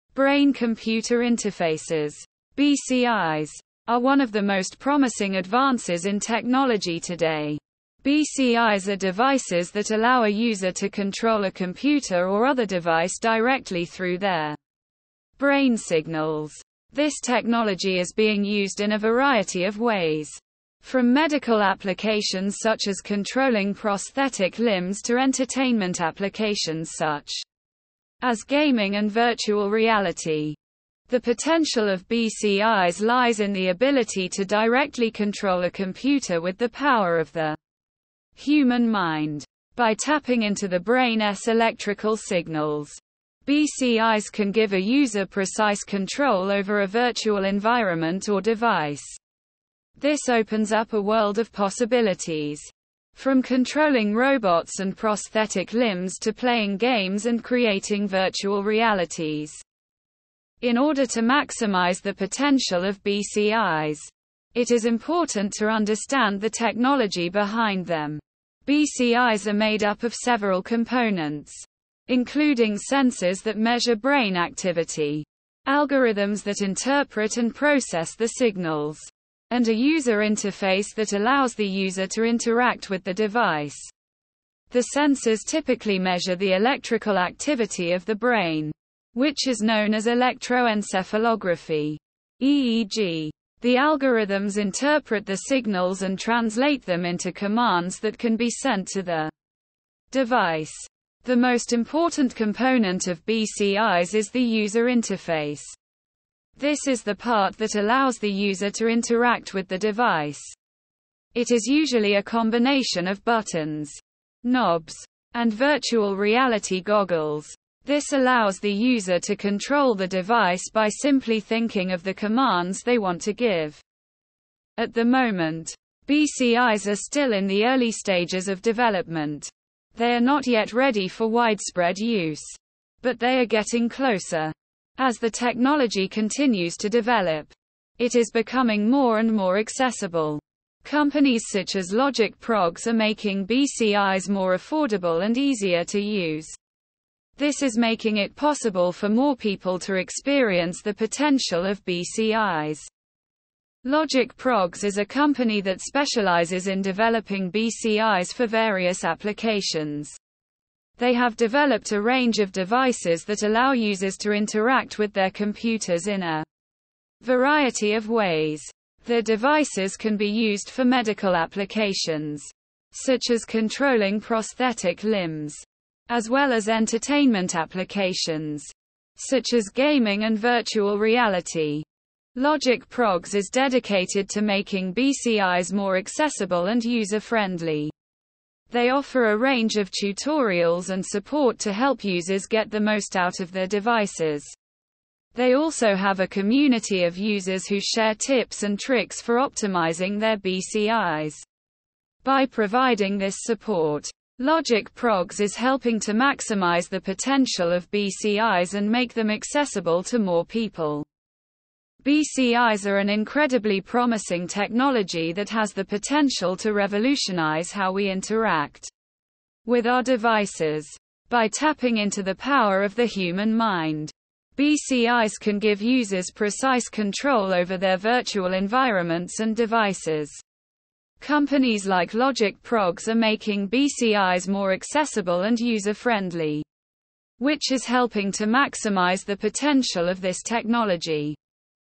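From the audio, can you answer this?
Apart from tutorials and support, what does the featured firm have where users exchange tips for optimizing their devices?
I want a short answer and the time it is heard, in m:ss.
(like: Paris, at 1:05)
a community of users, at 3:16.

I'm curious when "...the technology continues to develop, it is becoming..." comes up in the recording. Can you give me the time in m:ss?
2:15.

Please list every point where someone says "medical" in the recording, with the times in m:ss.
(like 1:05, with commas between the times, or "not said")
0:21, 2:50.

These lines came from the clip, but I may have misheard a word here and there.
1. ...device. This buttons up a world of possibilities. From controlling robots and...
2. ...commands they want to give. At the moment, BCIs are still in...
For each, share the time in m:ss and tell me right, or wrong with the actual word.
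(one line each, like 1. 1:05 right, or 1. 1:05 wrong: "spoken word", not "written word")
1. 0:48 wrong: "opens", not "buttons"
2. 2:02 right.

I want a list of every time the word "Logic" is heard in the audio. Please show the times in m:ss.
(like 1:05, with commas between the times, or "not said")
2:21, 2:33, 3:02, 3:24, 3:52.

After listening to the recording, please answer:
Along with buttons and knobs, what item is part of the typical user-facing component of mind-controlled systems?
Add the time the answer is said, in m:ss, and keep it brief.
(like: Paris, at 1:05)
virtual reality goggles, at 1:55.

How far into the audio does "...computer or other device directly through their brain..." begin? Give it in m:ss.
0:11.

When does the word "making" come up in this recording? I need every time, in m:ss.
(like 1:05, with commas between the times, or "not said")
2:22, 2:27, 3:04, 3:53.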